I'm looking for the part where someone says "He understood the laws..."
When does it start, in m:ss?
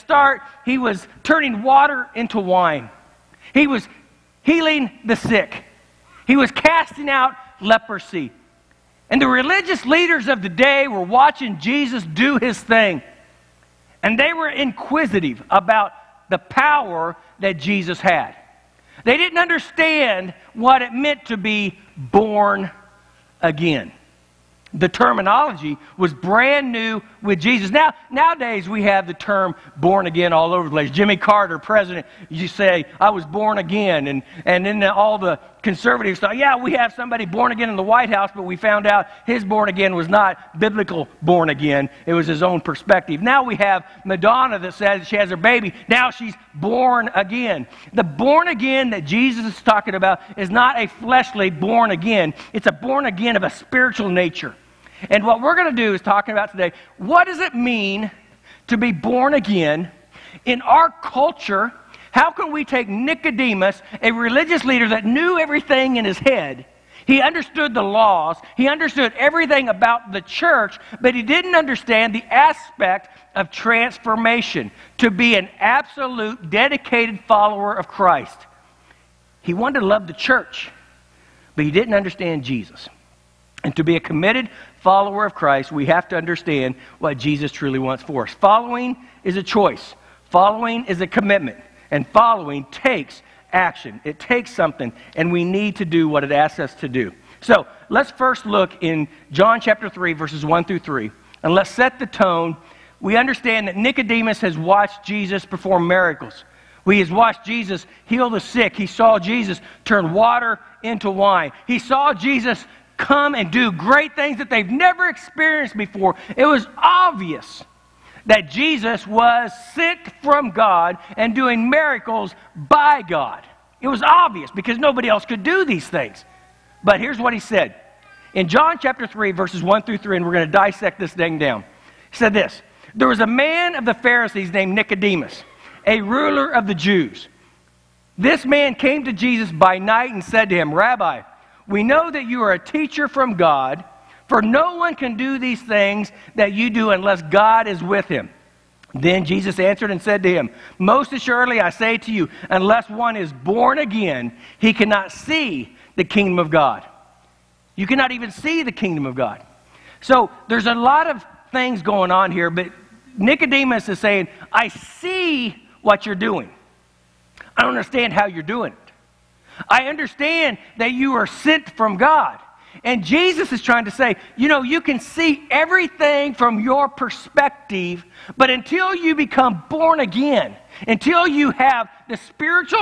1:07.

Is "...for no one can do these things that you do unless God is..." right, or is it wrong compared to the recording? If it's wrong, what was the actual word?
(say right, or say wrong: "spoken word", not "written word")
right.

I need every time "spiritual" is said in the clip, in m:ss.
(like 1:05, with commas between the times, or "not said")
0:53, 3:02.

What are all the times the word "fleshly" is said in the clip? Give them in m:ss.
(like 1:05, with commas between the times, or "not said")
0:50.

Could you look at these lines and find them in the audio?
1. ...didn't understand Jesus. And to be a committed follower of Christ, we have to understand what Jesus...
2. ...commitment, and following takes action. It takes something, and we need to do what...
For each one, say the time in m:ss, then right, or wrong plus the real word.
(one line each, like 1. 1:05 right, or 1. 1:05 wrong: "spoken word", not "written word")
1. 1:21 right
2. 1:31 right.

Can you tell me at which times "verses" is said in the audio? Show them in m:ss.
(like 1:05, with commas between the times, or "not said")
1:40, 2:09.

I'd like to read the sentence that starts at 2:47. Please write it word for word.
I don't understand how you're doing it.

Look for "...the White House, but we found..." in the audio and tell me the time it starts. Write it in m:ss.
0:37.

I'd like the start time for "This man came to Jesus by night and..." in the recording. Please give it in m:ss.
2:18.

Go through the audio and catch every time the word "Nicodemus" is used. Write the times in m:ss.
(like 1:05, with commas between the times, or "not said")
1:02, 1:43, 2:14, 2:43.